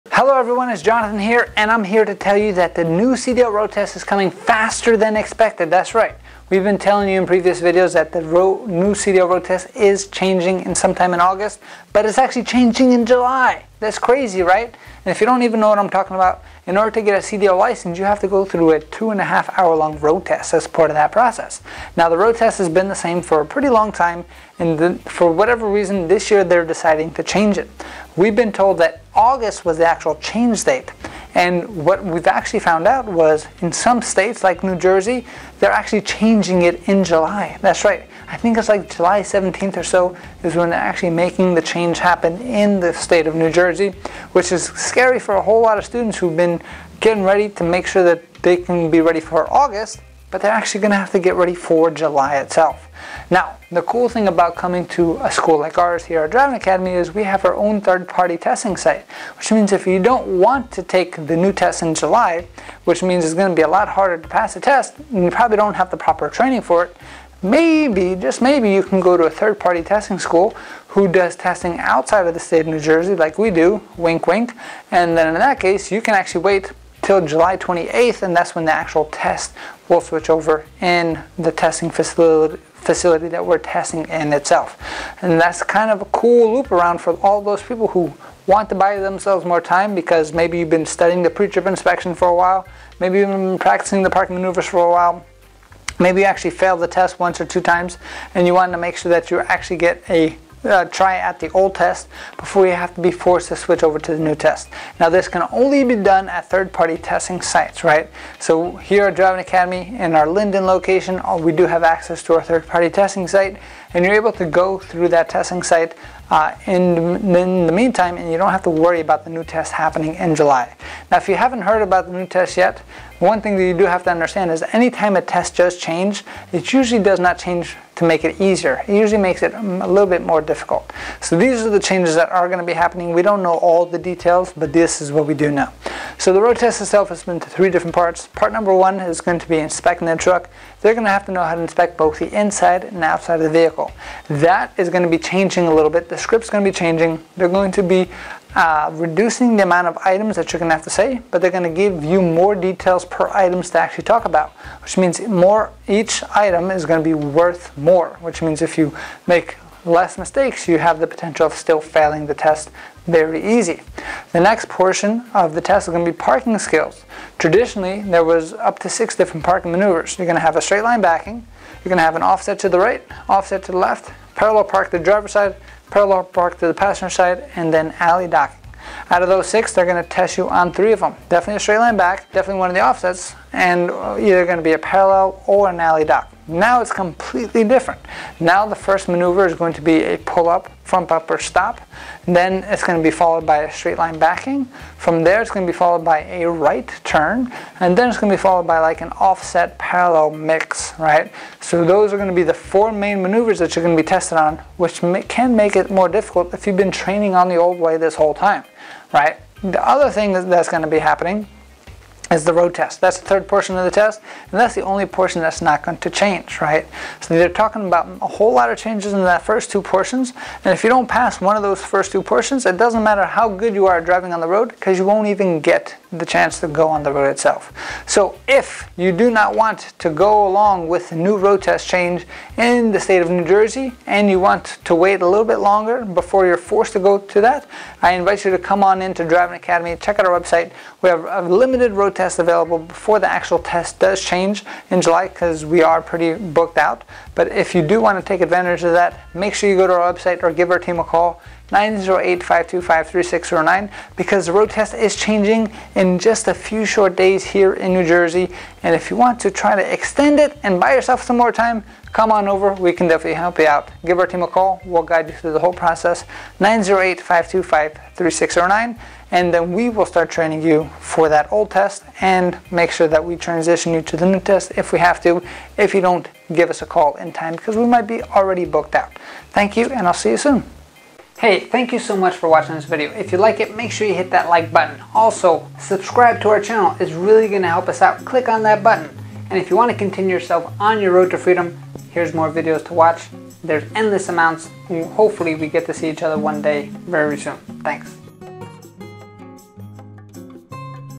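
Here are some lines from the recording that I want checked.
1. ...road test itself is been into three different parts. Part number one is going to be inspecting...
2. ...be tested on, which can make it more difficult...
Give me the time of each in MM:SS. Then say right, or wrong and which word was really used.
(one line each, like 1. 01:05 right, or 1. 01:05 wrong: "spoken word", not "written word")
1. 02:16 right
2. 03:24 right.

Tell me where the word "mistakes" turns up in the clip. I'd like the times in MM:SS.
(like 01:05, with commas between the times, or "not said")
02:40.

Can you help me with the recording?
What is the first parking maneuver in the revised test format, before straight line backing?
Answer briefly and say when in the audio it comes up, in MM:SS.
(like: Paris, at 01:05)
pull up front bumper stop, at 03:10.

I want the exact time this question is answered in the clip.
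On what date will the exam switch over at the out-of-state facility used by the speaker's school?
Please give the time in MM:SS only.
01:17.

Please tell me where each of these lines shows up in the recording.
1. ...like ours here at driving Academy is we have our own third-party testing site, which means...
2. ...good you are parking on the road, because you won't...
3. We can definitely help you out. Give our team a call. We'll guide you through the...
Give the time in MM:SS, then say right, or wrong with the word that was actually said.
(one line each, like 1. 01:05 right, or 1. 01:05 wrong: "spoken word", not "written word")
1. 00:55 right
2. 03:43 wrong: "driving", not "parking"
3. 04:22 right.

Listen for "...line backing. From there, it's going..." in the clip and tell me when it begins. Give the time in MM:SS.
03:13.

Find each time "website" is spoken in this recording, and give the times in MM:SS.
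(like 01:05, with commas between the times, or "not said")
04:00, 04:10.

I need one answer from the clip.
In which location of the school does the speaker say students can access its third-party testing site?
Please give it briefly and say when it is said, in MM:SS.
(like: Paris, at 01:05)
Linden, at 01:50.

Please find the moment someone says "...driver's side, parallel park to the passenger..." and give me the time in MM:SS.
02:54.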